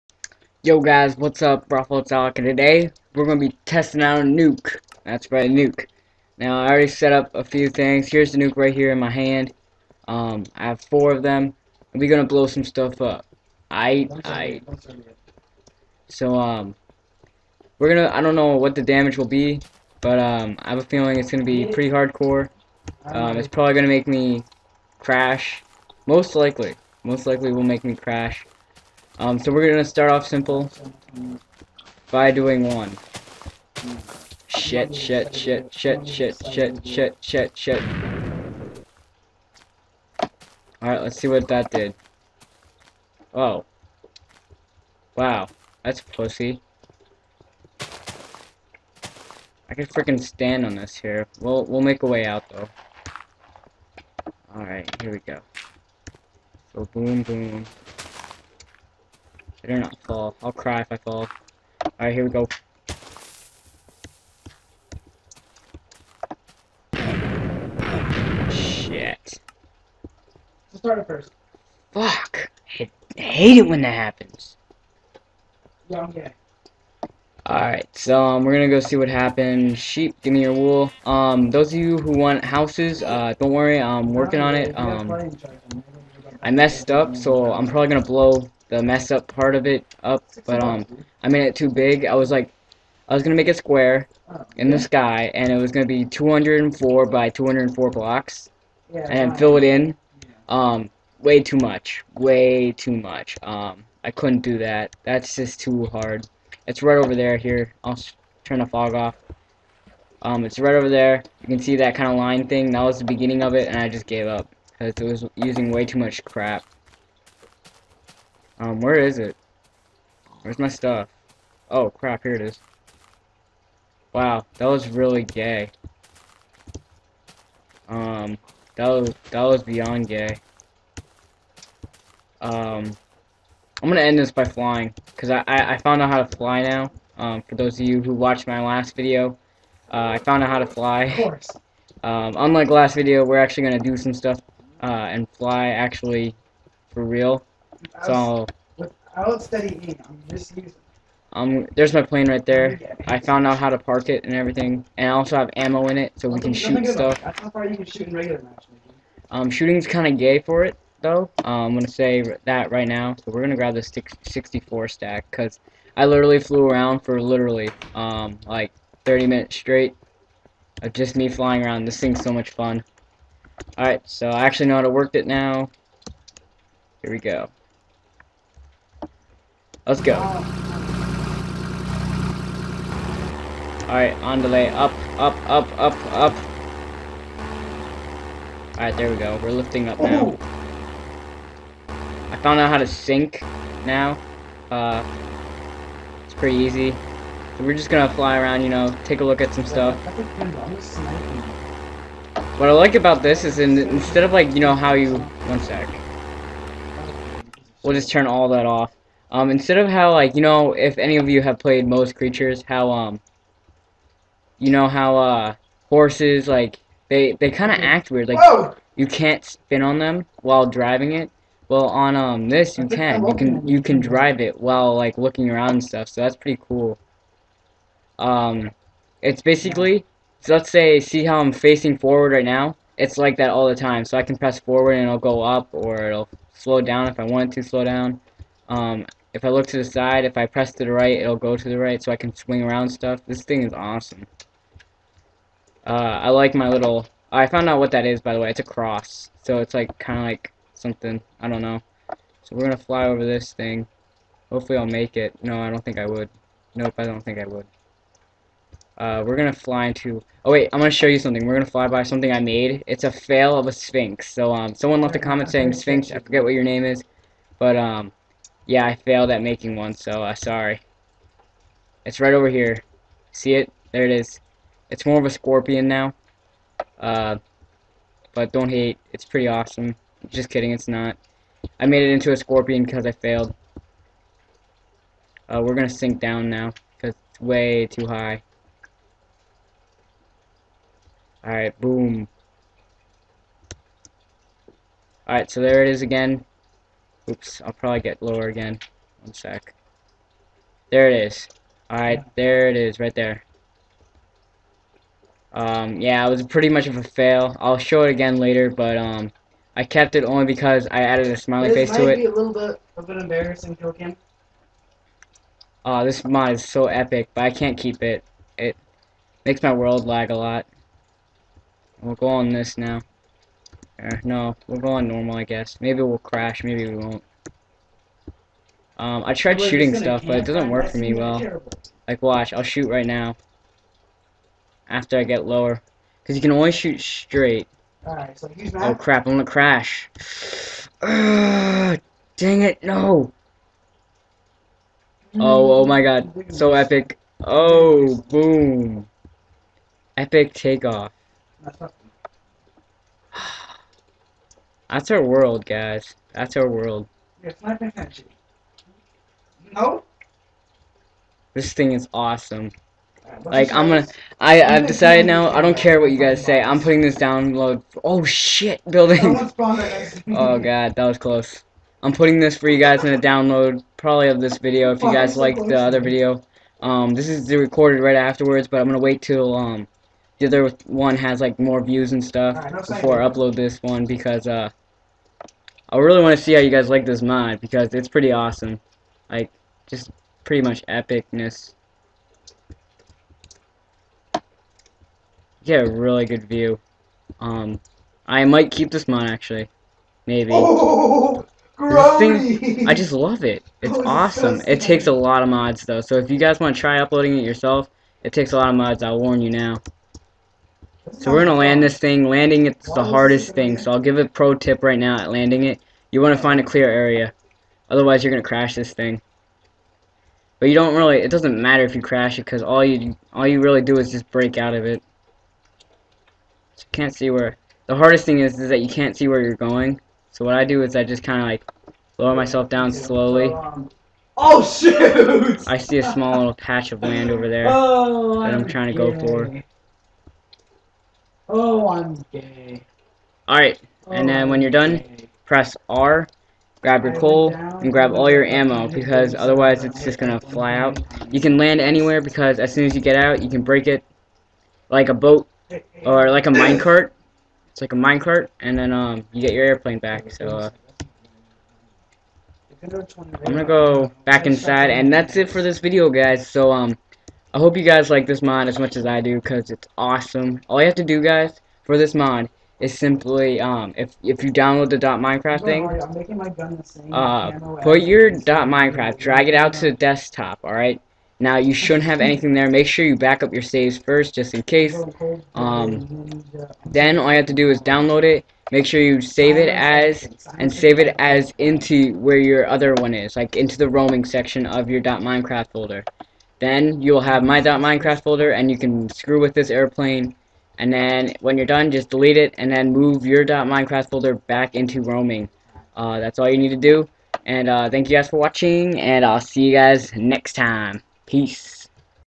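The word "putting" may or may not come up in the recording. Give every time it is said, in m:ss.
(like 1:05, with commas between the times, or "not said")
6:06, 6:12.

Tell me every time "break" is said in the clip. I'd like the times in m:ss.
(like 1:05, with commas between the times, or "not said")
7:04, 7:33.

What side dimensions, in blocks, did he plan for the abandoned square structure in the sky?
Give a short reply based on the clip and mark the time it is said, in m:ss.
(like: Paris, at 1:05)
204 by 204, at 1:36.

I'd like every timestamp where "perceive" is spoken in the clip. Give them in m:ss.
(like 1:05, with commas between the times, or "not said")
not said.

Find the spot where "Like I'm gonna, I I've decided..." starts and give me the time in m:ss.
6:03.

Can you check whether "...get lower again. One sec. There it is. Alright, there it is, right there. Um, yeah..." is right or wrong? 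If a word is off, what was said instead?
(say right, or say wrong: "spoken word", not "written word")
right.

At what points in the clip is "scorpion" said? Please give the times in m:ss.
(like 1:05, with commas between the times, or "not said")
4:35, 4:42.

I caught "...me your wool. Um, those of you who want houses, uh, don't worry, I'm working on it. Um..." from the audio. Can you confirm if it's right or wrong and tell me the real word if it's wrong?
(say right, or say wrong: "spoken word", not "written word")
right.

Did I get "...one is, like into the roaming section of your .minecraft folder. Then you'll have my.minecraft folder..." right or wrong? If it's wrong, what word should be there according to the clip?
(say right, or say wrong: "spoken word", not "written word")
right.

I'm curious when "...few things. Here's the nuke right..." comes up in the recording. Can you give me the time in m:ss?
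0:07.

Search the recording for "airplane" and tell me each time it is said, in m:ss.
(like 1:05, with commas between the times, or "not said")
7:39, 8:19.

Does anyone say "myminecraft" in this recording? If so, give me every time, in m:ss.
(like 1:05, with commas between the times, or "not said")
8:17.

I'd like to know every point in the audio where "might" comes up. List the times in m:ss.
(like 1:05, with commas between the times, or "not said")
5:12, 6:38.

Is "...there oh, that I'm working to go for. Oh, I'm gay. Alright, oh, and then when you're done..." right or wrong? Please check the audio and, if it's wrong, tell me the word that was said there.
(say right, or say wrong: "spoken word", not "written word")
wrong: "trying", not "working".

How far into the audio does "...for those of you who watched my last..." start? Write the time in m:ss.
2:17.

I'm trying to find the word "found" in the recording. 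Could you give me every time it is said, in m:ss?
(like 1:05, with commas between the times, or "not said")
2:15, 2:20, 2:33, 3:12, 4:07.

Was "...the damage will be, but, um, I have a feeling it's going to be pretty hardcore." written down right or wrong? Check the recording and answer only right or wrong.
right.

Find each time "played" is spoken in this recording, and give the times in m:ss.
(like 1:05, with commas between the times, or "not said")
3:31.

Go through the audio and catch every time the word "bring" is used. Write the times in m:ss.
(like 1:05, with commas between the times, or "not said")
not said.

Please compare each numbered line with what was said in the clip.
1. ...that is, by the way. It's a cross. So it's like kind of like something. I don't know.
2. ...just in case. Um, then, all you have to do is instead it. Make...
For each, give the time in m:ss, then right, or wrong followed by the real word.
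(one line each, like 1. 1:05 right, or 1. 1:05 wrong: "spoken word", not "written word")
1. 4:07 right
2. 8:04 wrong: "download", not "instead".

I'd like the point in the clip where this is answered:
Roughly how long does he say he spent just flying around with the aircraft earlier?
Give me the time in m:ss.
2:49.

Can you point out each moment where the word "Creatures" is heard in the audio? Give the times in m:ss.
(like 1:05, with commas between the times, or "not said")
3:32.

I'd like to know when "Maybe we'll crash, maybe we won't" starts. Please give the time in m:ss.
5:25.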